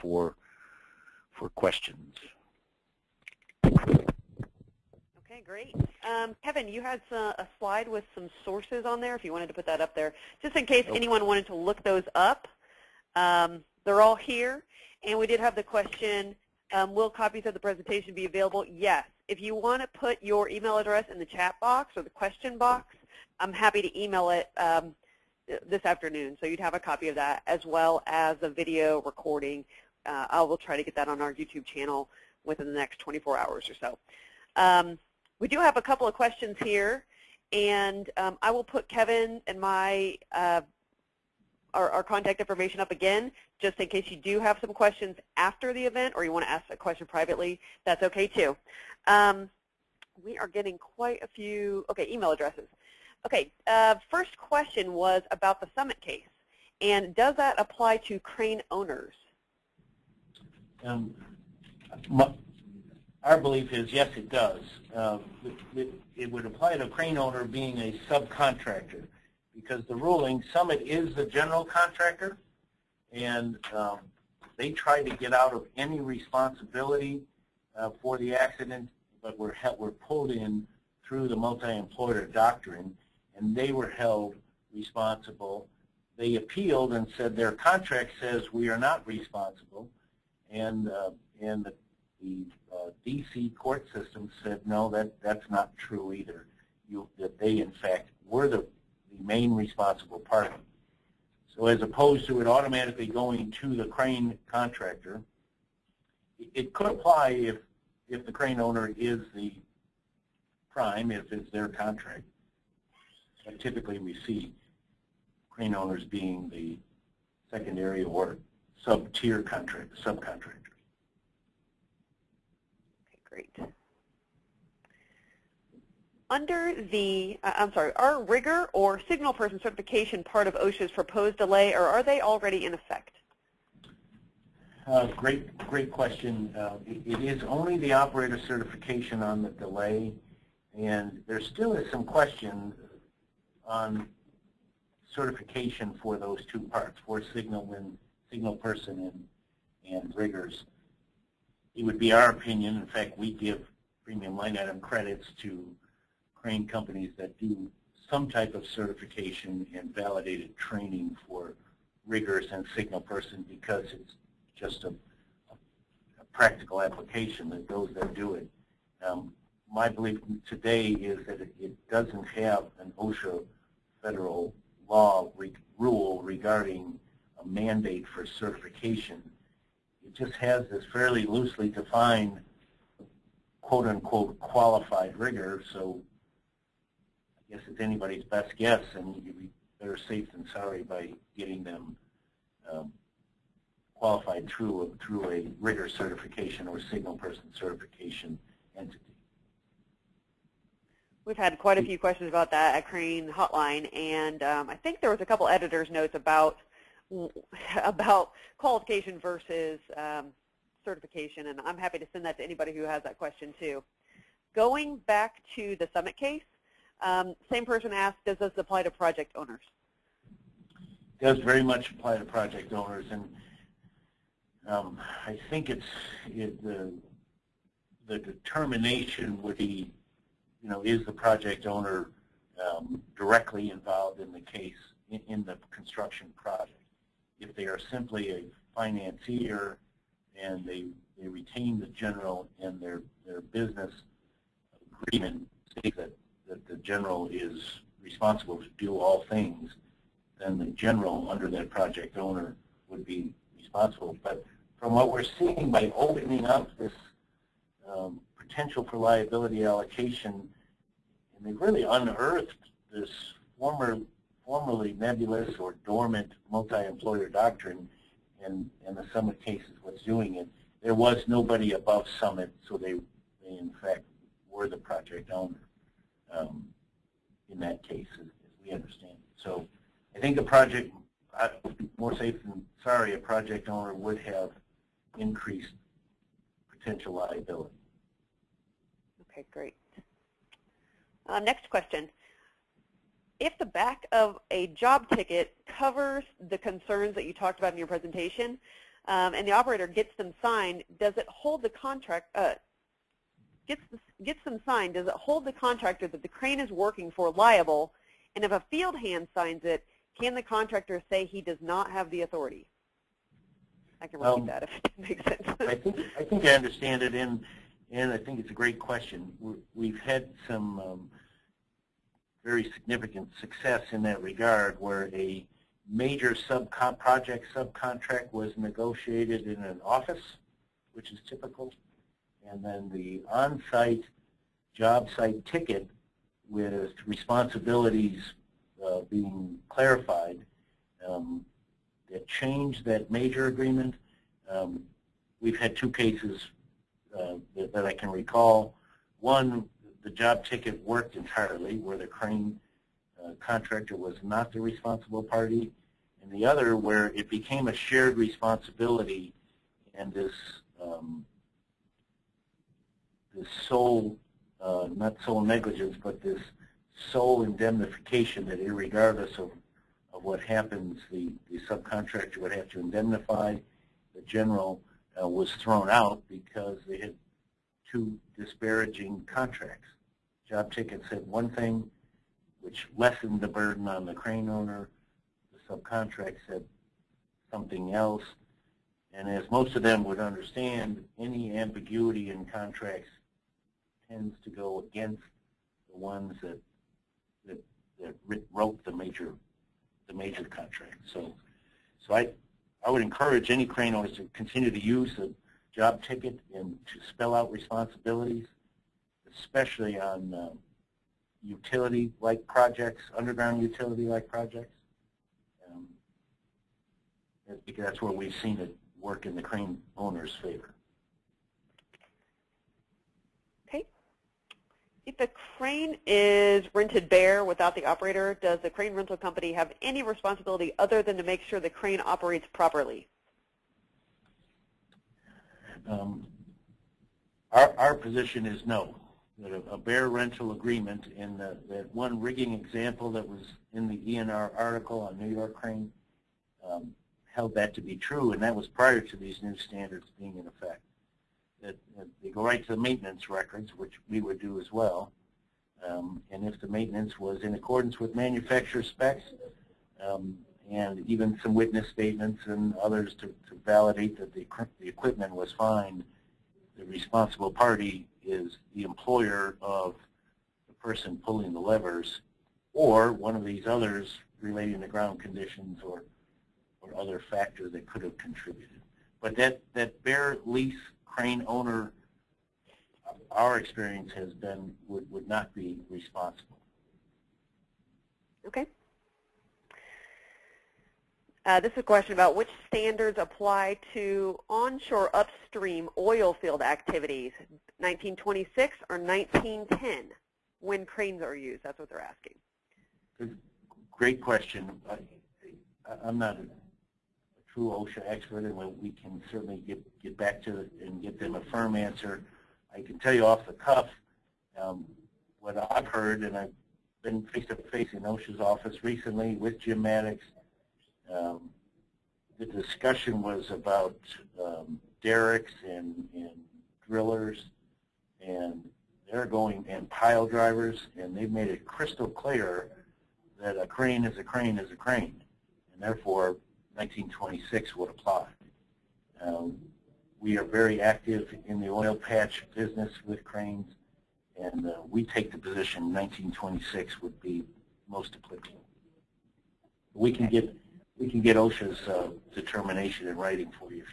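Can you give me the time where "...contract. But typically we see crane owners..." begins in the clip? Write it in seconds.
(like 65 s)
111 s.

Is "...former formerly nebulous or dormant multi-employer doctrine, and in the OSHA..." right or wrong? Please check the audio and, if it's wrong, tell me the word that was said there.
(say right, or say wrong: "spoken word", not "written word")
wrong: "Summit", not "OSHA".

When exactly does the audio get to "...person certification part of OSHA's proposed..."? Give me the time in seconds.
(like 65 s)
129 s.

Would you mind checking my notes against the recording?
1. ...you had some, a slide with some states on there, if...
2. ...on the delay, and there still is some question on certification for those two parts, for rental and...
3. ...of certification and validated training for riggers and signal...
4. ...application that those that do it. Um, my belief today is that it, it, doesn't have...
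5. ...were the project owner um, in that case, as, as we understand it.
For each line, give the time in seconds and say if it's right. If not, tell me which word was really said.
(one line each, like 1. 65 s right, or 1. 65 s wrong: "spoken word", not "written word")
1. 6 s wrong: "sources", not "states"
2. 139 s wrong: "signal", not "rental"
3. 158 s right
4. 166 s right
5. 274 s right.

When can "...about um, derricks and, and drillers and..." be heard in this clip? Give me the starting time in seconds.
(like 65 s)
523 s.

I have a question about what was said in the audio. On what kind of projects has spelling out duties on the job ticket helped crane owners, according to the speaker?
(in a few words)
underground utility-like projects.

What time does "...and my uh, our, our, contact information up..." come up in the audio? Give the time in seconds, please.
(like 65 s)
39 s.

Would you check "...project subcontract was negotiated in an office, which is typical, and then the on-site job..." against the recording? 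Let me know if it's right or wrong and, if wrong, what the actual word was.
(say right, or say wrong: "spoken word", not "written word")
right.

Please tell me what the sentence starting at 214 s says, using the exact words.
Going back to the summit case, um, same person asked, does this apply to project owners?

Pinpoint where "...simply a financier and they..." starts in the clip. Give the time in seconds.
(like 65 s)
237 s.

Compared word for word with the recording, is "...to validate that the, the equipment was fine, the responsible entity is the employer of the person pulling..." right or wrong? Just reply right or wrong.
wrong.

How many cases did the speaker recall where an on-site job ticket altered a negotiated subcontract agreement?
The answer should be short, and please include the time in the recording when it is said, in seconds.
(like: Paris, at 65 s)
2, at 345 s.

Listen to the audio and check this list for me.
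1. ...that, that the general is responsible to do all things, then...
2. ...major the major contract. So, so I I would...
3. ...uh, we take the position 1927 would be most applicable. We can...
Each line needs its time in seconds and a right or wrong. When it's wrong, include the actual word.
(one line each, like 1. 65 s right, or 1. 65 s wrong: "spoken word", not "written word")
1. 245 s right
2. 398 s right
3. 544 s wrong: "1926", not "1927".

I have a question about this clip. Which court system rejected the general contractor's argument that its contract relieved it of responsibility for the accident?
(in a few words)
D.C. court system.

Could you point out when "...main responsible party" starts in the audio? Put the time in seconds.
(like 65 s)
99 s.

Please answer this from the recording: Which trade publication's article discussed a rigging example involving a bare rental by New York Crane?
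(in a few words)
ENR.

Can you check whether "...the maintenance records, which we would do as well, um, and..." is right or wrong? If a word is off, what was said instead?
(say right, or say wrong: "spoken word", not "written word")
right.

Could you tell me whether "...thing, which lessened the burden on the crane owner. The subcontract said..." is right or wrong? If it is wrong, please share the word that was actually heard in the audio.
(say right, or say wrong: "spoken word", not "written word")
right.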